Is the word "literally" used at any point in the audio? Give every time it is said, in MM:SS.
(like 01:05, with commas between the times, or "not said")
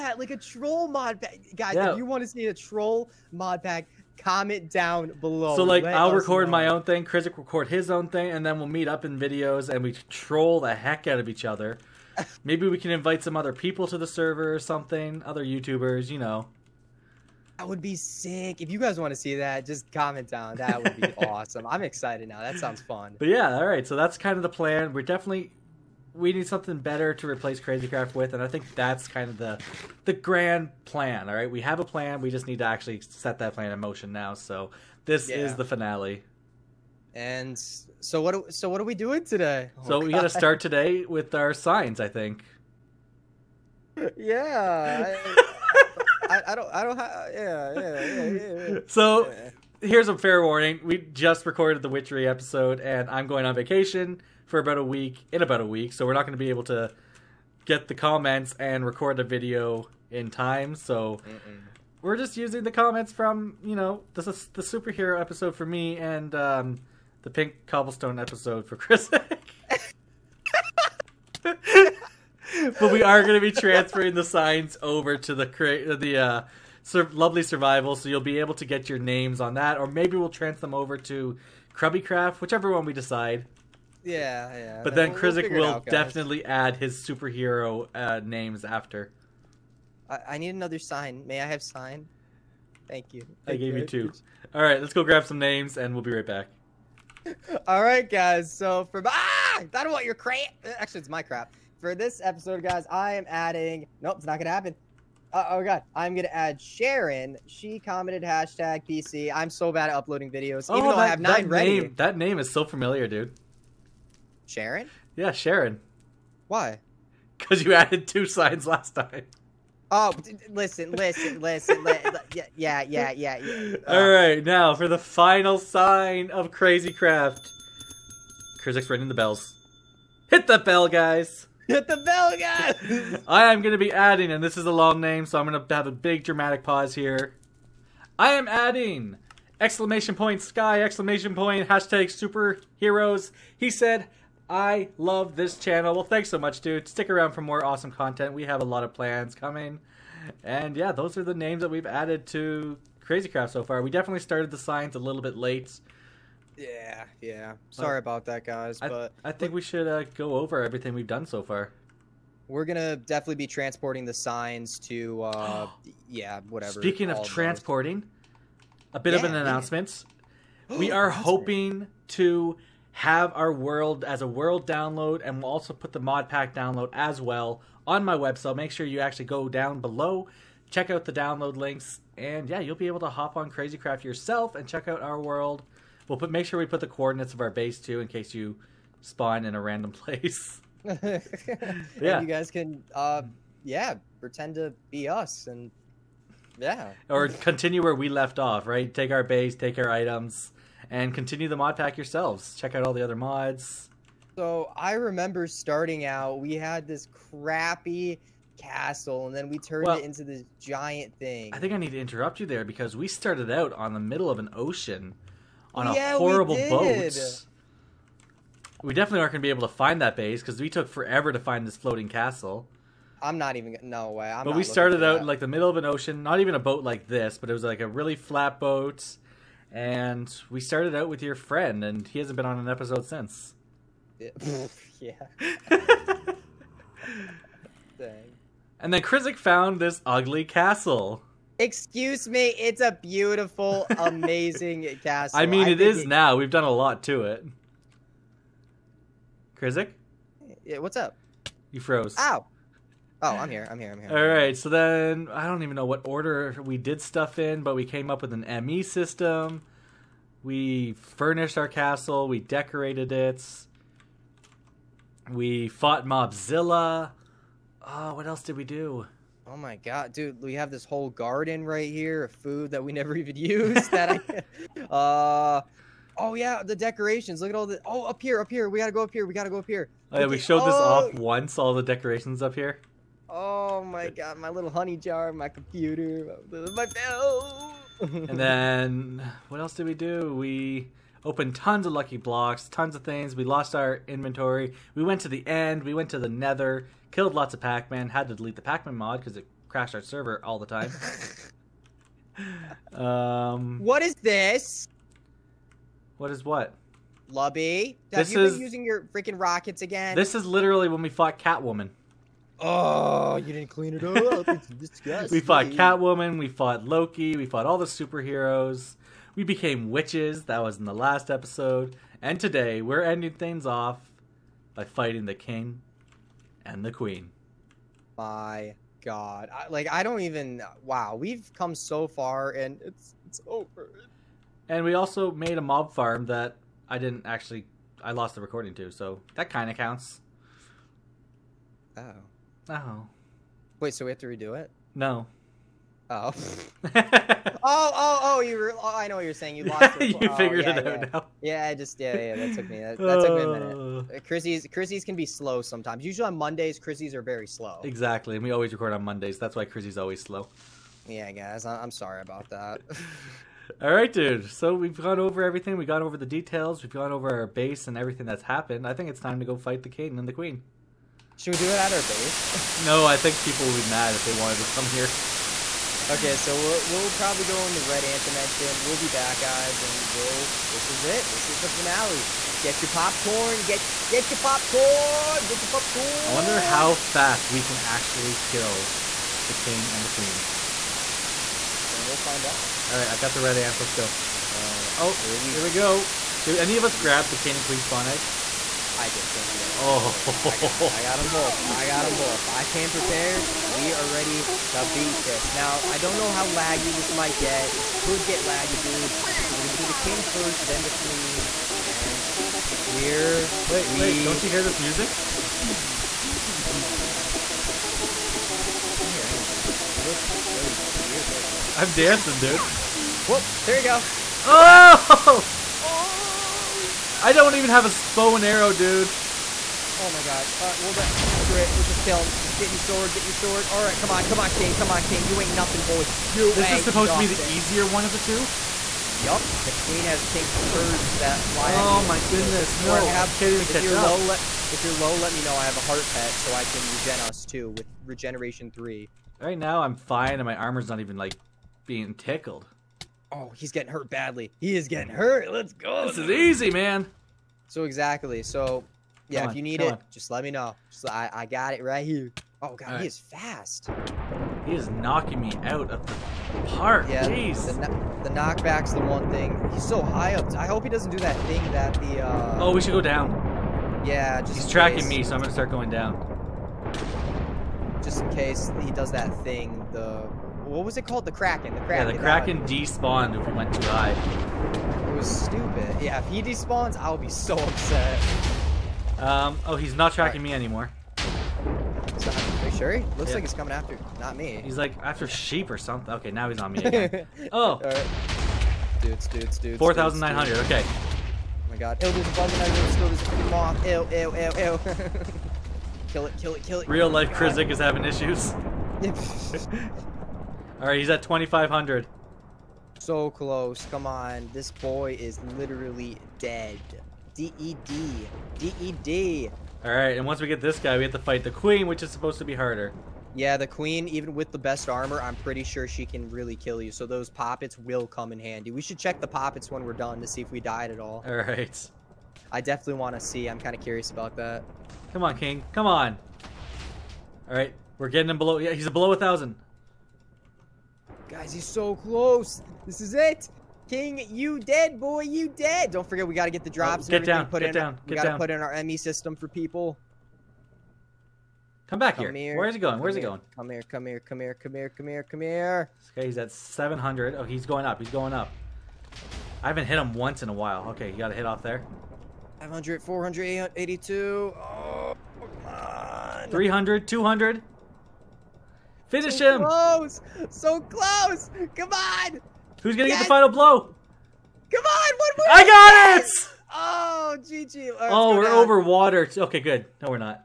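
05:10, 08:35.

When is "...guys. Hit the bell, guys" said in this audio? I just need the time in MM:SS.
02:10.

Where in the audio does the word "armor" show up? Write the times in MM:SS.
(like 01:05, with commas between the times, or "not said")
07:30, 08:44.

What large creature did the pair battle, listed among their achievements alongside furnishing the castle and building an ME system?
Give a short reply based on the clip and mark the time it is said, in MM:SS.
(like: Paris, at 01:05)
Mobzilla, at 04:26.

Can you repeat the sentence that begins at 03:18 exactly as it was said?
Right, take our base, take our items, and continue the mod pack yourselves.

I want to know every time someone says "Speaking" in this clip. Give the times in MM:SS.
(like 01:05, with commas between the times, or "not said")
02:46.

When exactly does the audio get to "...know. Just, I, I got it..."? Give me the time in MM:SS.
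07:40.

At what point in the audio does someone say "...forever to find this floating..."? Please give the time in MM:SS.
03:40.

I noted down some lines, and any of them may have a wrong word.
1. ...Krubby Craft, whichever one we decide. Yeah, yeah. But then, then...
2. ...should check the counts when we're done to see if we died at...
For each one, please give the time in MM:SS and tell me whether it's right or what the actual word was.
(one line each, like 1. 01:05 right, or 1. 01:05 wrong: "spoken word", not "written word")
1. 01:21 right
2. 08:48 wrong: "poppets", not "counts".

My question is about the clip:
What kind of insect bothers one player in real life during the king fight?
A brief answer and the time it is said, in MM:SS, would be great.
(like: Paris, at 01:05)
A moth, at 08:23.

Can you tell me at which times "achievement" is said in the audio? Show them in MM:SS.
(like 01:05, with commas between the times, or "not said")
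not said.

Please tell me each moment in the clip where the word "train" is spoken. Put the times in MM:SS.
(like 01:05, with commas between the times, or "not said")
not said.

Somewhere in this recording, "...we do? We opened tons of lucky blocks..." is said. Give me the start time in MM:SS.
04:49.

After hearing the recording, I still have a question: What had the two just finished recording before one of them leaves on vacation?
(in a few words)
Witchery.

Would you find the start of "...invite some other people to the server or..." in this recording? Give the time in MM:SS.
00:12.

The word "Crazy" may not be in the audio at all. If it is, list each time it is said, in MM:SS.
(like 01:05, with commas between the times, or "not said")
00:27, 02:06, 02:33, 03:03.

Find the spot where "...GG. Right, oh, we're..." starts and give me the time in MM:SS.
09:37.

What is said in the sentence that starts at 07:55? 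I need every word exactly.
me, so I'm gonna start going down.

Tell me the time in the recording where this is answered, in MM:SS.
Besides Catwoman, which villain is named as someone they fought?
05:16.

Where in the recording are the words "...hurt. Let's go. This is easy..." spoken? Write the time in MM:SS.
07:35.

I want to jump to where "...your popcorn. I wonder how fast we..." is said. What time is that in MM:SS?
06:25.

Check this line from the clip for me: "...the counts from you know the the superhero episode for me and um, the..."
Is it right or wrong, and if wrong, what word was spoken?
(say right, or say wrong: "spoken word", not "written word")
wrong: "comments", not "counts".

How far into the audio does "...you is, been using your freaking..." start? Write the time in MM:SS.
05:08.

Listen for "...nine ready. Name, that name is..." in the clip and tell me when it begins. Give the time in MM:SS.
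01:51.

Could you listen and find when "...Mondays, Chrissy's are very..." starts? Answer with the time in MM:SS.
05:56.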